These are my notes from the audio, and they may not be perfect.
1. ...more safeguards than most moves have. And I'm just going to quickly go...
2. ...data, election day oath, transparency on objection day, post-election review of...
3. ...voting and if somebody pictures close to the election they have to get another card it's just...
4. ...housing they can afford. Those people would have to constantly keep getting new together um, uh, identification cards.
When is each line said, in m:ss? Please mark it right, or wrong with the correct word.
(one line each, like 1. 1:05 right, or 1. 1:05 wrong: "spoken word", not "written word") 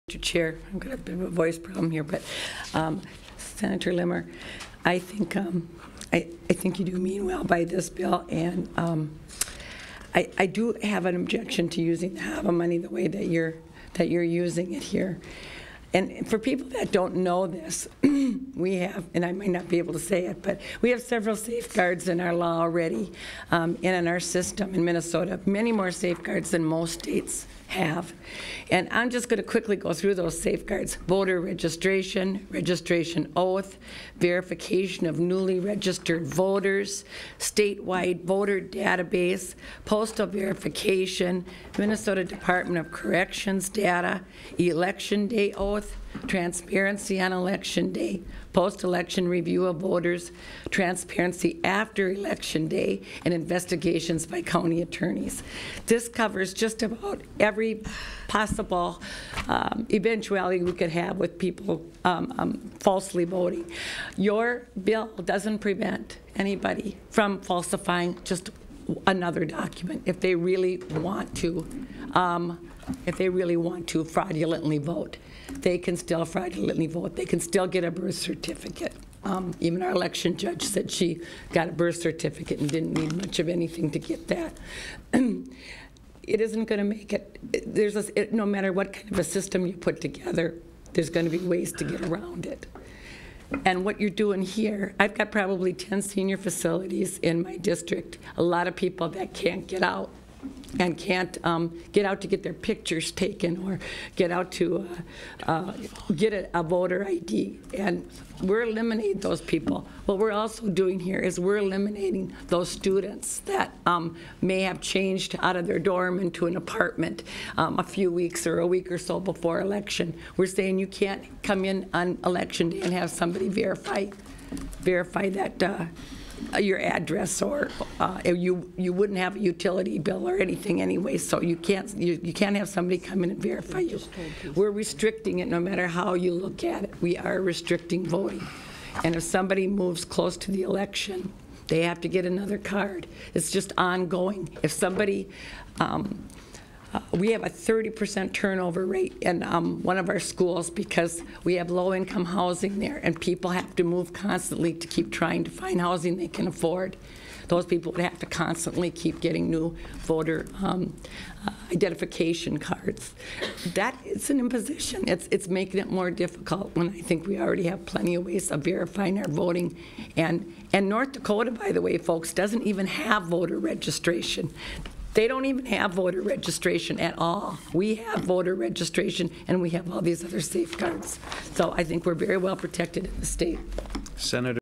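1. 0:25 wrong: "states", not "moves"
2. 0:43 wrong: "election", not "objection"
3. 2:18 wrong: "moves", not "pictures"
4. 2:35 wrong: "voter", not "together".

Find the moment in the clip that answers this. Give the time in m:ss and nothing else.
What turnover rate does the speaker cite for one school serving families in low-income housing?
2:27.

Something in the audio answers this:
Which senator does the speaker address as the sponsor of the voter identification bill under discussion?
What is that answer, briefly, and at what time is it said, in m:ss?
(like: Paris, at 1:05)
Senator Limmer, at 0:03.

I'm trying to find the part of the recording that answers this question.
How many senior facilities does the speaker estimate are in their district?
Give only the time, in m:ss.
1:35.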